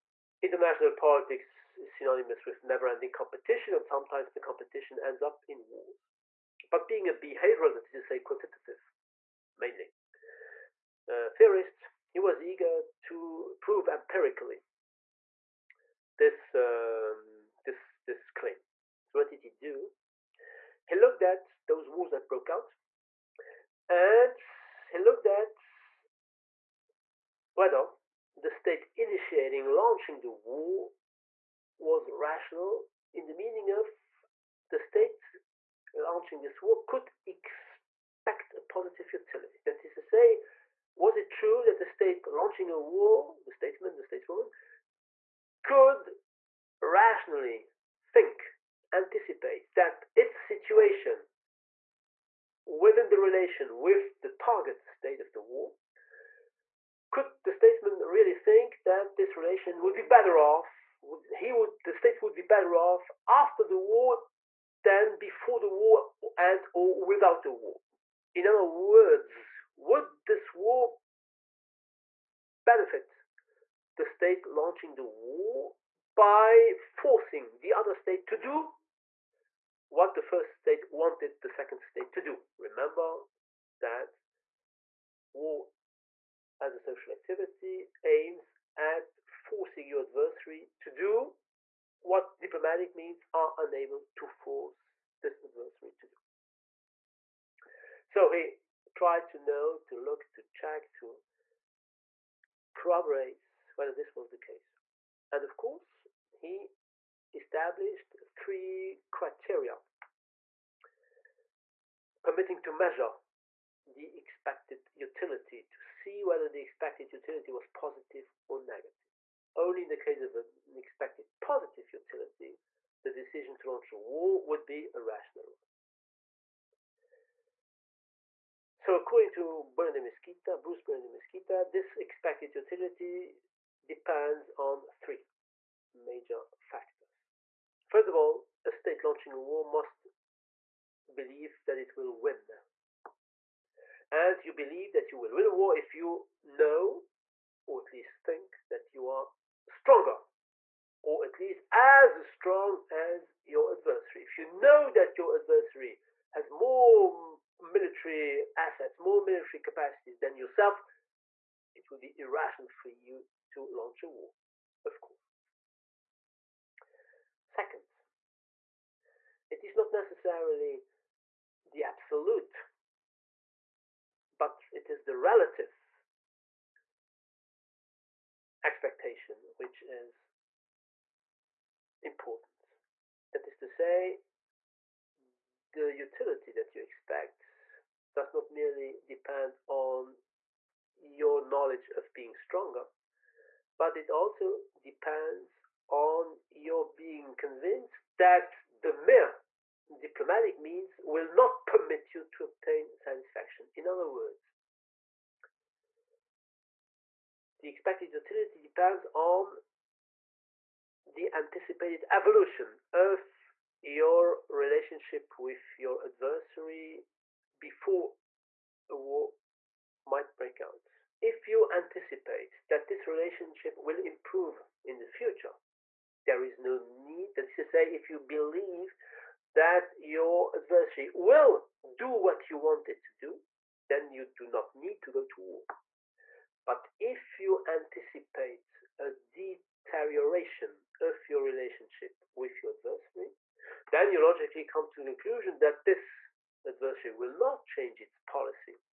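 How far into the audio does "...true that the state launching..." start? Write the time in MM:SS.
00:41.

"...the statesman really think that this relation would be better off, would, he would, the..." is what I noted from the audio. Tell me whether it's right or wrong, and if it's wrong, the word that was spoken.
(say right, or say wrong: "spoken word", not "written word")
right.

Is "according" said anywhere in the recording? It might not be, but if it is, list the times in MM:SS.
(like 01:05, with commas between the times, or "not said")
02:08.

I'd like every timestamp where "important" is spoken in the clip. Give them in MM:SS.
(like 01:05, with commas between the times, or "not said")
03:02.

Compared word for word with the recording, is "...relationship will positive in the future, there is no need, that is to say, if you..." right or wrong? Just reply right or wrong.
wrong.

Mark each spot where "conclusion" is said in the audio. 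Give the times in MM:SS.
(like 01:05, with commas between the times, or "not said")
04:05.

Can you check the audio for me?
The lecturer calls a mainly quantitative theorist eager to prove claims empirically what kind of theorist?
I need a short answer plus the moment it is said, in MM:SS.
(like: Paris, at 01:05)
behavioral, at 00:07.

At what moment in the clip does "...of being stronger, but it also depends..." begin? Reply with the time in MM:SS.
03:11.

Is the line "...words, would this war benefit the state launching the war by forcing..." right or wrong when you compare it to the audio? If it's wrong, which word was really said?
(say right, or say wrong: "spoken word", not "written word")
right.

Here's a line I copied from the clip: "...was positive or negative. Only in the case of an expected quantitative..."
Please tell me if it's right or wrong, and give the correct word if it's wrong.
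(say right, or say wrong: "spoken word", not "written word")
wrong: "positive", not "quantitative".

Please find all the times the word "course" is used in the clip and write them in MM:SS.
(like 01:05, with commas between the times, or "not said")
01:45, 02:45.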